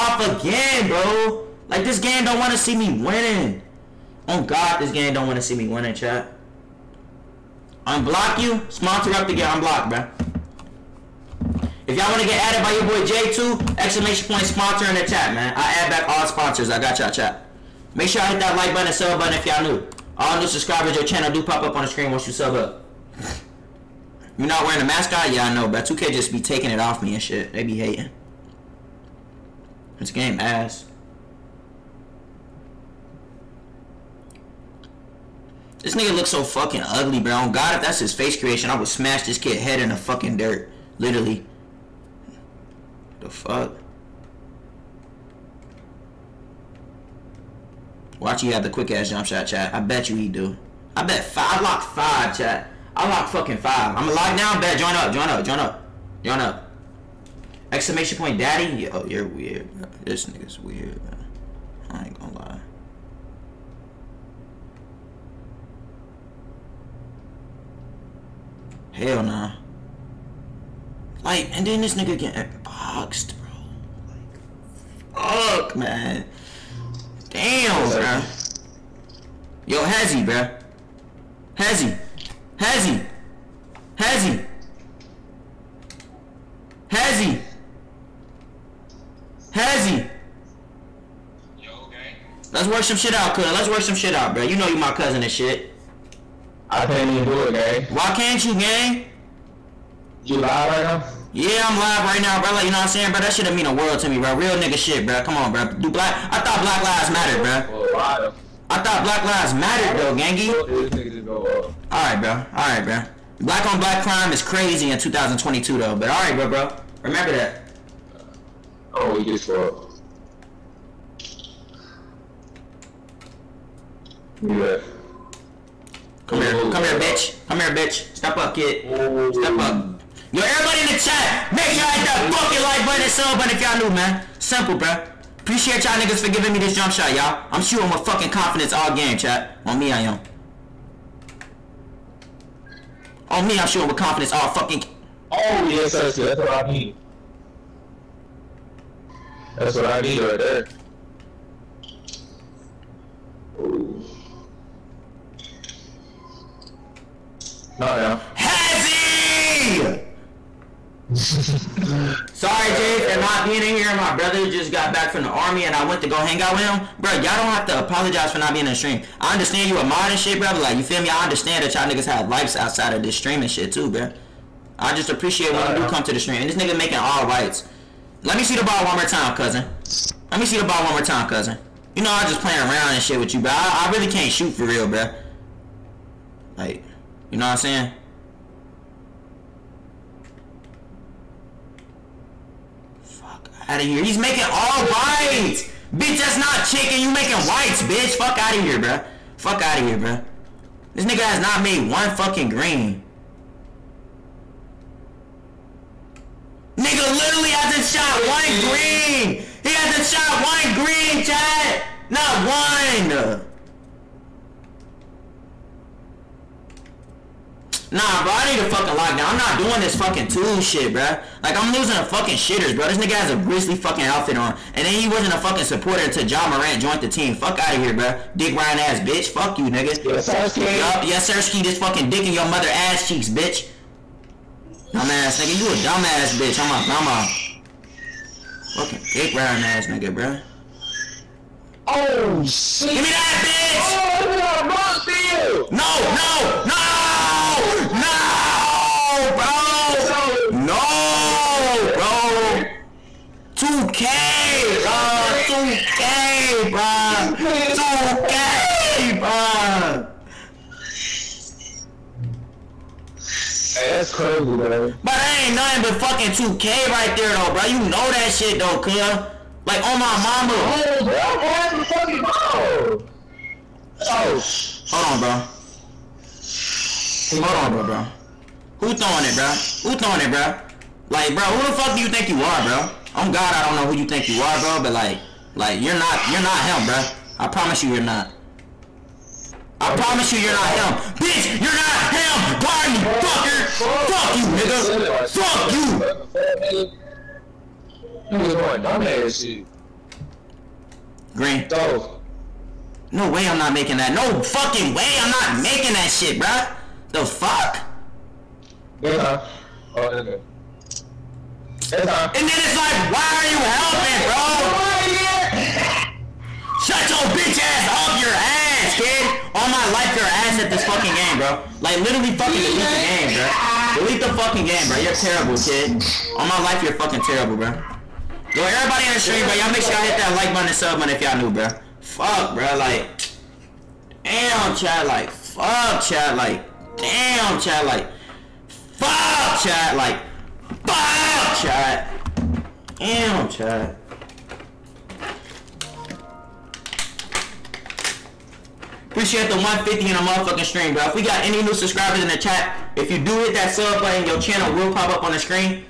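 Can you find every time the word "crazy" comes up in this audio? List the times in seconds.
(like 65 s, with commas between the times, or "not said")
114 s, 264 s.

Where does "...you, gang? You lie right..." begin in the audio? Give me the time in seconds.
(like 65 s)
98 s.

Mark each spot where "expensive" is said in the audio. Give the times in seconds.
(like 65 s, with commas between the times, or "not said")
not said.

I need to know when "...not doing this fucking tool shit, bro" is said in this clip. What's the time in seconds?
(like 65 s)
219 s.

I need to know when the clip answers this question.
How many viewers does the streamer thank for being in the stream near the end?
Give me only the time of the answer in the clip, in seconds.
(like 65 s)
349 s.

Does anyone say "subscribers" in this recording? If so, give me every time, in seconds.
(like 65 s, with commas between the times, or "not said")
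20 s, 351 s.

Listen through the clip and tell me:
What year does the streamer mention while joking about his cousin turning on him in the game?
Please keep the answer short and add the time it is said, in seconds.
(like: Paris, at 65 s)
2022, at 114 s.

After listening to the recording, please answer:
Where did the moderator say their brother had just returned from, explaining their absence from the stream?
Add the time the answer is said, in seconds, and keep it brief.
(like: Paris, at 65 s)
the army, at 165 s.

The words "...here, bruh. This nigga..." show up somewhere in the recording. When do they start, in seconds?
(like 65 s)
199 s.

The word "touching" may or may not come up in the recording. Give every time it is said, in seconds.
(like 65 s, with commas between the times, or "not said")
not said.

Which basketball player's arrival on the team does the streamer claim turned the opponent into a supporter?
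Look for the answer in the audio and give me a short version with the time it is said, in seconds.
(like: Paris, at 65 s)
Ja Morant, at 226 s.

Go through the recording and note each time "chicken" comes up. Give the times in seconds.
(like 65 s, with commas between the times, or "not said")
196 s.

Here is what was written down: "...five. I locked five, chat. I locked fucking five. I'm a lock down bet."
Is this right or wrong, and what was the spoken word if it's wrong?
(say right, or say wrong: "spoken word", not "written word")
right.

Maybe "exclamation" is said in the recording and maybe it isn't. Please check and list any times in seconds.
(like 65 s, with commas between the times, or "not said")
13 s, 57 s.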